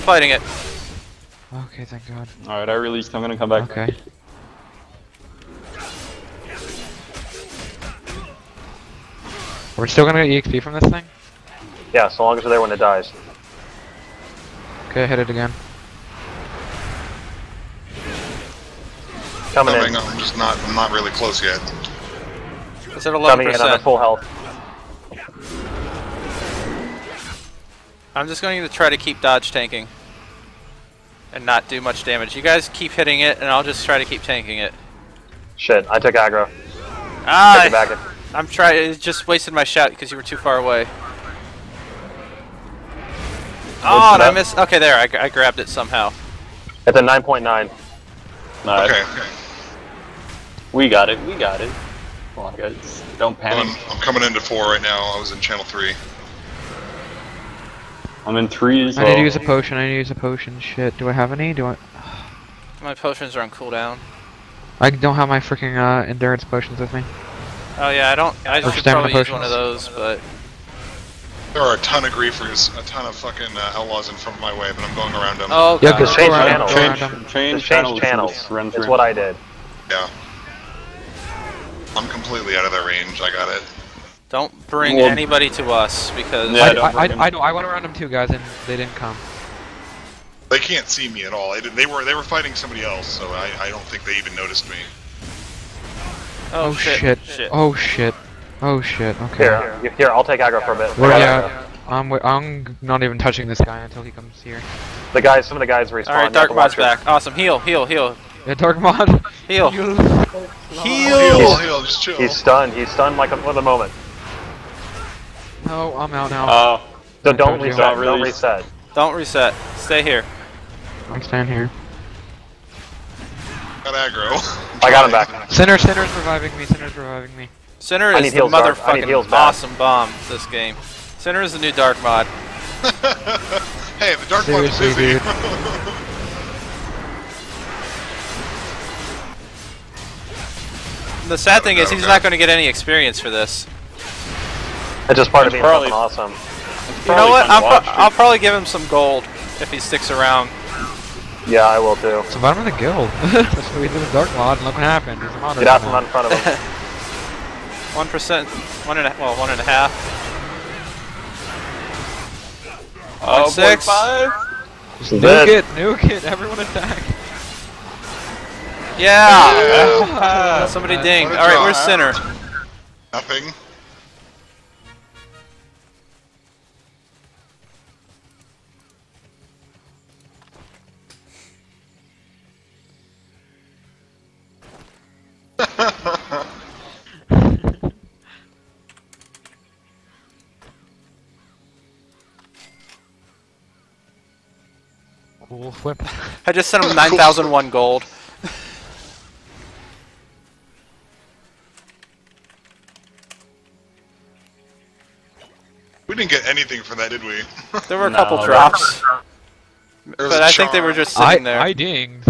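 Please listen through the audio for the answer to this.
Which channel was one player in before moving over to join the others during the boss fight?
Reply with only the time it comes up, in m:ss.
0:55.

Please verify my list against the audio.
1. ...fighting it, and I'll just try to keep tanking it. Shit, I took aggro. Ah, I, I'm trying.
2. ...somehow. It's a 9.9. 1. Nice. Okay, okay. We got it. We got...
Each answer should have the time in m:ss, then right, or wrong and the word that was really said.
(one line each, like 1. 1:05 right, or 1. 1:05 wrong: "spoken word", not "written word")
1. 0:32 wrong: "hitting", not "fighting"
2. 0:45 wrong: "9", not "1".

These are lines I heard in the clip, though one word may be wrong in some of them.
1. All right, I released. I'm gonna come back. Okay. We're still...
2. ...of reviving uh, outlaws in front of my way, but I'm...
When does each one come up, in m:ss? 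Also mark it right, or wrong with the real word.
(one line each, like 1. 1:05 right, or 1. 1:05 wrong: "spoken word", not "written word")
1. 0:02 right
2. 1:13 wrong: "fucking", not "reviving".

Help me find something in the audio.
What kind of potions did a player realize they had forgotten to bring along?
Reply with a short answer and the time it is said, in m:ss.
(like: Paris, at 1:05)
Endurance potions, at 1:06.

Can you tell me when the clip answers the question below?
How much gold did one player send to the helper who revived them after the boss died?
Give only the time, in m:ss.
3:16.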